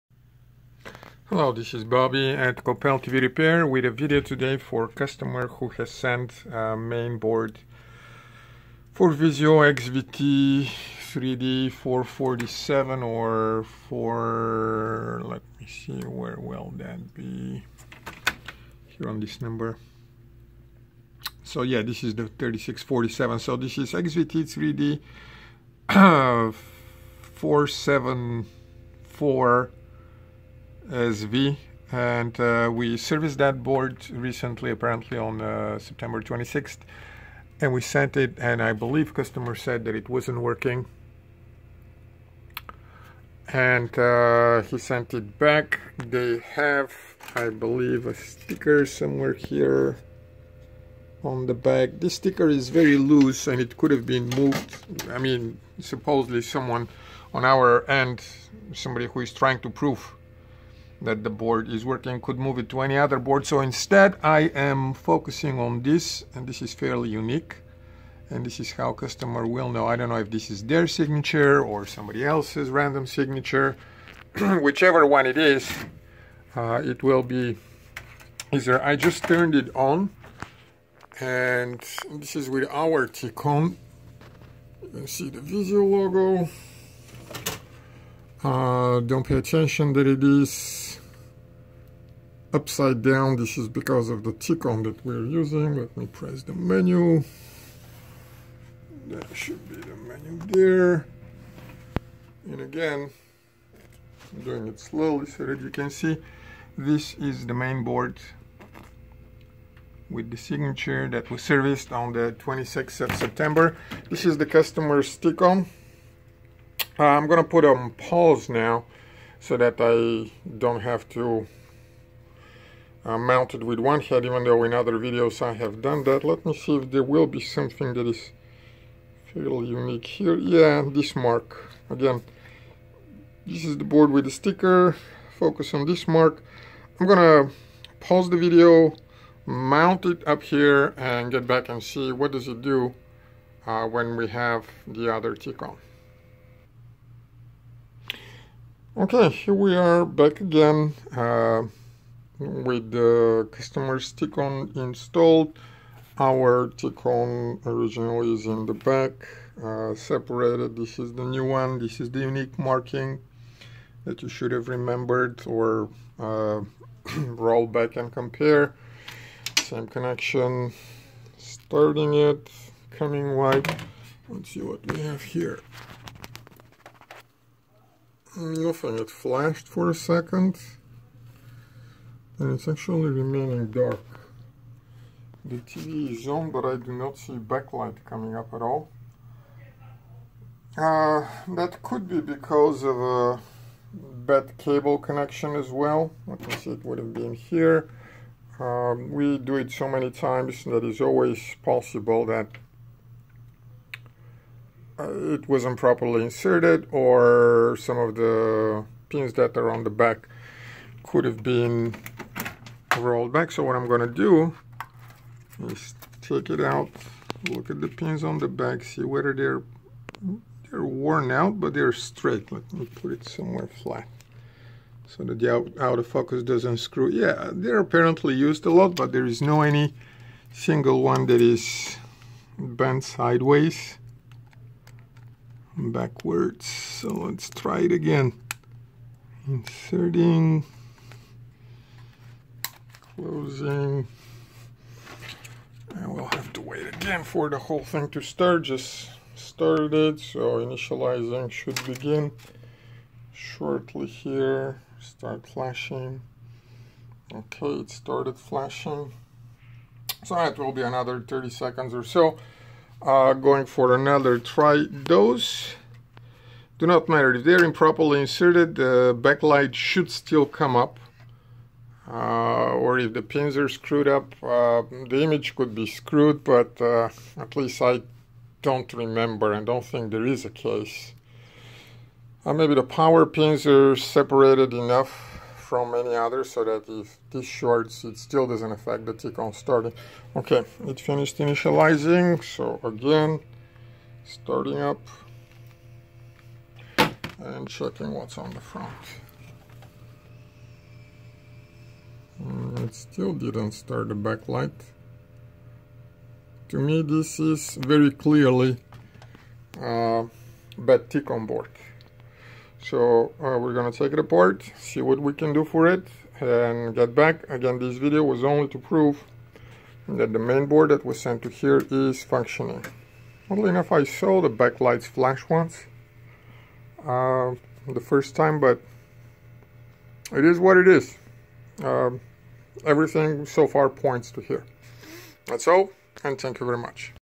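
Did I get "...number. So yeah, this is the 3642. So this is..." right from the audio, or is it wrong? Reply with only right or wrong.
wrong.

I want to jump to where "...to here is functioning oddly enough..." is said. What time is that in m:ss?
5:21.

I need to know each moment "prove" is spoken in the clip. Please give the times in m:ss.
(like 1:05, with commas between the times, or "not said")
0:59, 5:18.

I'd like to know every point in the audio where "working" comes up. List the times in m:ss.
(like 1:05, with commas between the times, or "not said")
0:40, 1:01.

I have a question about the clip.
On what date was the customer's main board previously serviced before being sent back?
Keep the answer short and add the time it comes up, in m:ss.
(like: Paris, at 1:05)
September 26th, at 0:35.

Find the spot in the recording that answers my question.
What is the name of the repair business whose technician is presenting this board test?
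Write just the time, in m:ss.
0:02.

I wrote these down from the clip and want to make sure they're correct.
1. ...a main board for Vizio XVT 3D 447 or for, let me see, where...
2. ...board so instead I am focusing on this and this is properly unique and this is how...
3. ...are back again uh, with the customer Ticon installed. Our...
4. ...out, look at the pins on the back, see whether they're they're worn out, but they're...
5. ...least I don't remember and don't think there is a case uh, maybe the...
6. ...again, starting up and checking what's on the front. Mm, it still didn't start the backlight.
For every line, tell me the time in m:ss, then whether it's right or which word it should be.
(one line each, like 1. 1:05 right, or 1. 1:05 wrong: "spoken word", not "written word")
1. 0:06 right
2. 1:03 wrong: "fairly", not "properly"
3. 2:29 right
4. 3:36 right
5. 4:37 right
6. 4:52 right.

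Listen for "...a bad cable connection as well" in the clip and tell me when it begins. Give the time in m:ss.
3:12.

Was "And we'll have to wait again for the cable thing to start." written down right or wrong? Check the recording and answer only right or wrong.
wrong.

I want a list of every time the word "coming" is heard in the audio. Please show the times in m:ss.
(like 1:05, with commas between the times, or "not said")
2:52, 3:08.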